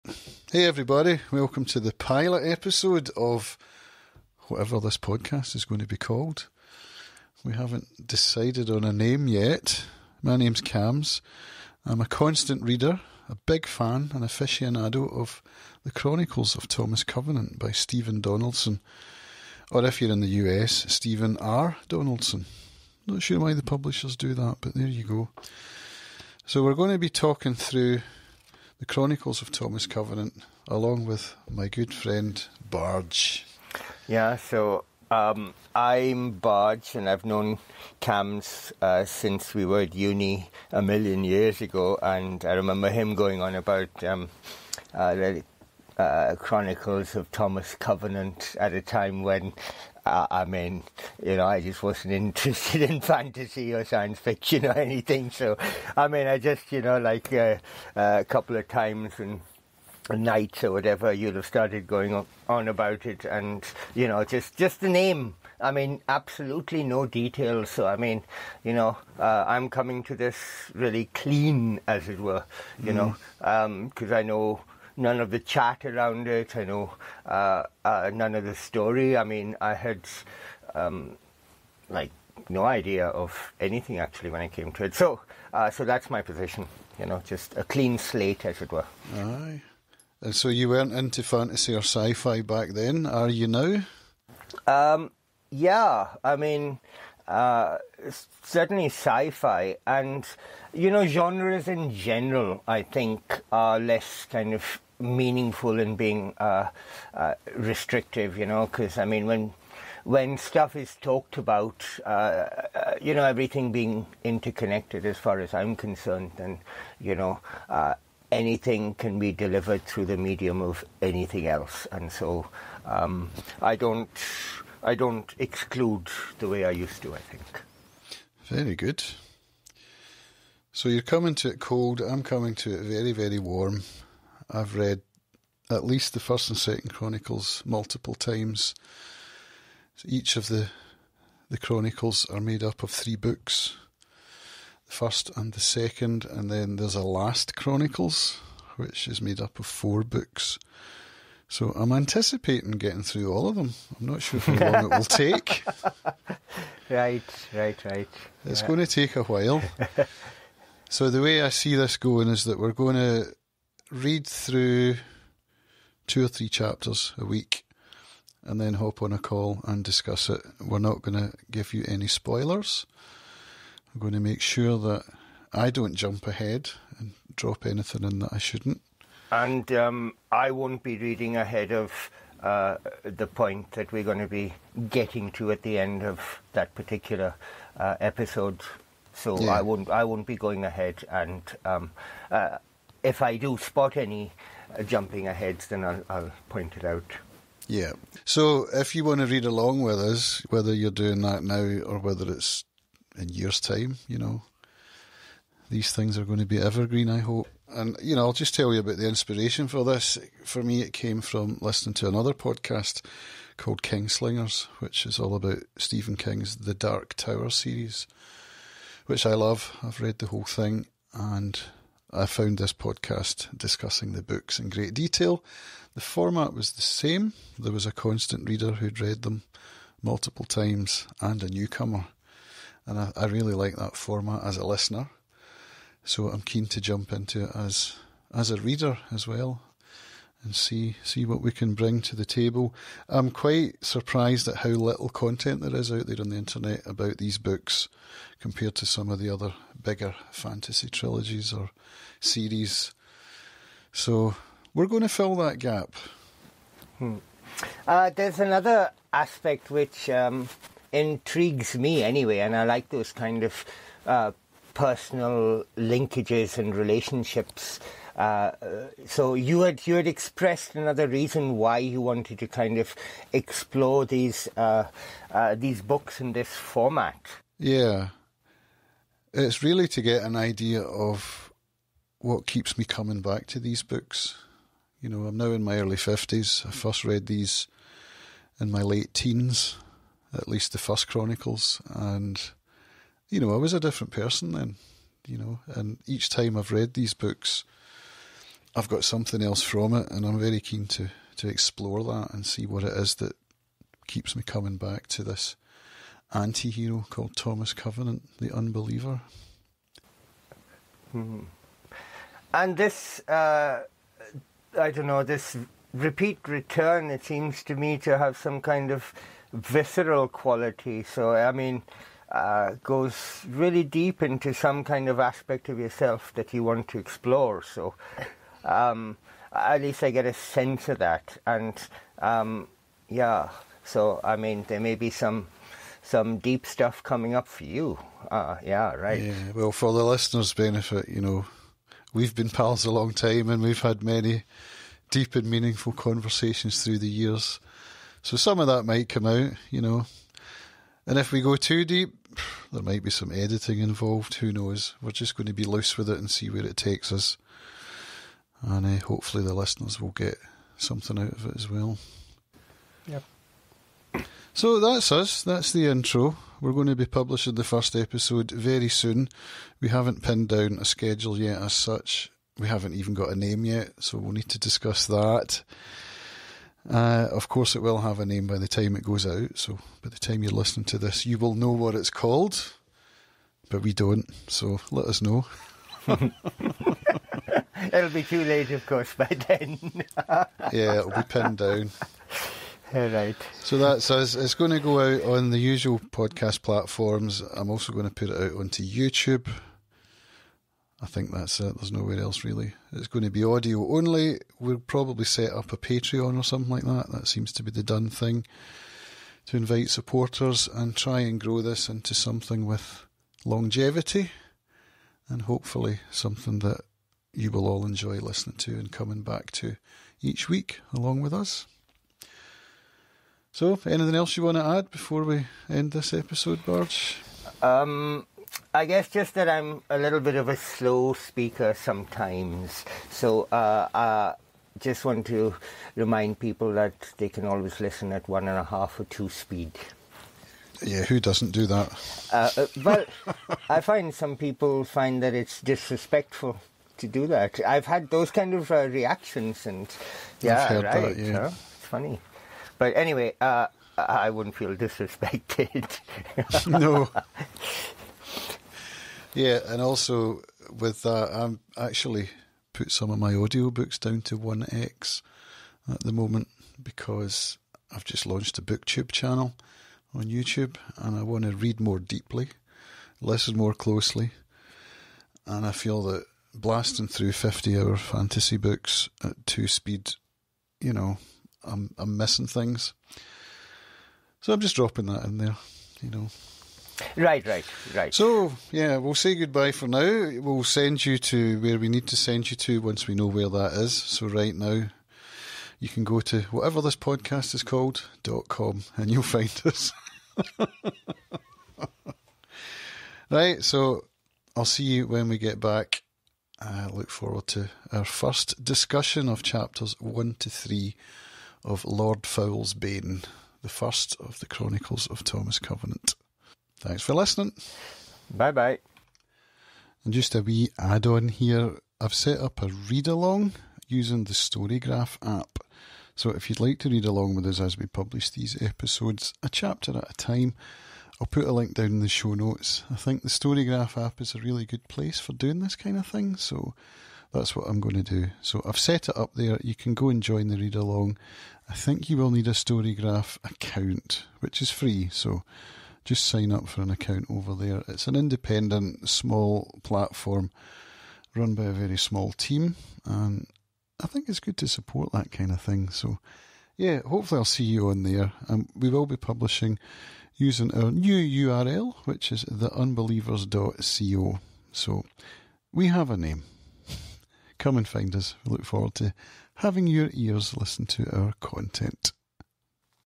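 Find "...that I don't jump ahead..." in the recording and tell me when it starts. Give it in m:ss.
2:54.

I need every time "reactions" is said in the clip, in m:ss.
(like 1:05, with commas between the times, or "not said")
7:28.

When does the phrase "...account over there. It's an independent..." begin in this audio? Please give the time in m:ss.
9:06.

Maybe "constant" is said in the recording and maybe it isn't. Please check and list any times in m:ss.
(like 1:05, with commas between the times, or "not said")
0:12, 3:47.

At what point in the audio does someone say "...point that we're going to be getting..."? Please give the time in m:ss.
3:03.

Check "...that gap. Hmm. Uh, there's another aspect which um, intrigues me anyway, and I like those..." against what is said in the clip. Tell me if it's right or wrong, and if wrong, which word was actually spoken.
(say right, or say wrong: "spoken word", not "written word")
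right.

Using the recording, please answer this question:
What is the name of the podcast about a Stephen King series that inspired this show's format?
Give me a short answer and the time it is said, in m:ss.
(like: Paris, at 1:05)
Kingslingers, at 3:33.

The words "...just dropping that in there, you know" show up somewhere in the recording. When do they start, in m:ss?
8:04.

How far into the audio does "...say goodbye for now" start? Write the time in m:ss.
8:09.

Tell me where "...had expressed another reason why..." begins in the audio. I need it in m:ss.
4:29.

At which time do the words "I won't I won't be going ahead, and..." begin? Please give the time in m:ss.
3:09.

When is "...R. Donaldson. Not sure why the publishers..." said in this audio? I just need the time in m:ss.
0:21.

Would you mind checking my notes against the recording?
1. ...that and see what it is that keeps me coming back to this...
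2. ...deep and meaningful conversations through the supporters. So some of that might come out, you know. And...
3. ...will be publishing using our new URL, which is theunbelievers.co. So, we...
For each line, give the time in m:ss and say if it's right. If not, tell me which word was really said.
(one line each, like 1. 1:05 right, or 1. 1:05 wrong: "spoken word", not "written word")
1. 5:02 right
2. 5:45 wrong: "years", not "supporters"
3. 9:18 right.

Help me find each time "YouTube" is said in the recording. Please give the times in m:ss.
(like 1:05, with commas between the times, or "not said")
6:38, 7:50.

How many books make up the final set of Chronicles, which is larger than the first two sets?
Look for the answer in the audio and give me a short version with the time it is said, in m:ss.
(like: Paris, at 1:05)
4, at 2:29.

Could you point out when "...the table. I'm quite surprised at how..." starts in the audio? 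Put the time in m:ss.
4:02.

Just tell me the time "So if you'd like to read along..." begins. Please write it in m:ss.
8:46.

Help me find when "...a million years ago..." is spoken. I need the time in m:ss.
0:40.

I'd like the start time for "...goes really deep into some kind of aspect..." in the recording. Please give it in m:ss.
5:22.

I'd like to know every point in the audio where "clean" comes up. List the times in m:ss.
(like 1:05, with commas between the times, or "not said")
1:11, 1:27.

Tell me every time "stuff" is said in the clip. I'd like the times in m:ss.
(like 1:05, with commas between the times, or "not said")
1:50, 5:36.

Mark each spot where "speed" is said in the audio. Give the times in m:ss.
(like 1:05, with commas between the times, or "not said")
7:19, 7:59.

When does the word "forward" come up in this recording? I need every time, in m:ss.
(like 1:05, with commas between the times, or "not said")
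8:27, 9:28.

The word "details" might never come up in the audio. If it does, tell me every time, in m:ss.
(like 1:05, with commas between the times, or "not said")
1:07, 3:44.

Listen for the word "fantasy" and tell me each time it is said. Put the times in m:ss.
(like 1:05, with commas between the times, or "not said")
0:53, 1:31, 4:10, 7:57.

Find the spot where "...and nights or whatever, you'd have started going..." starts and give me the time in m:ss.
0:59.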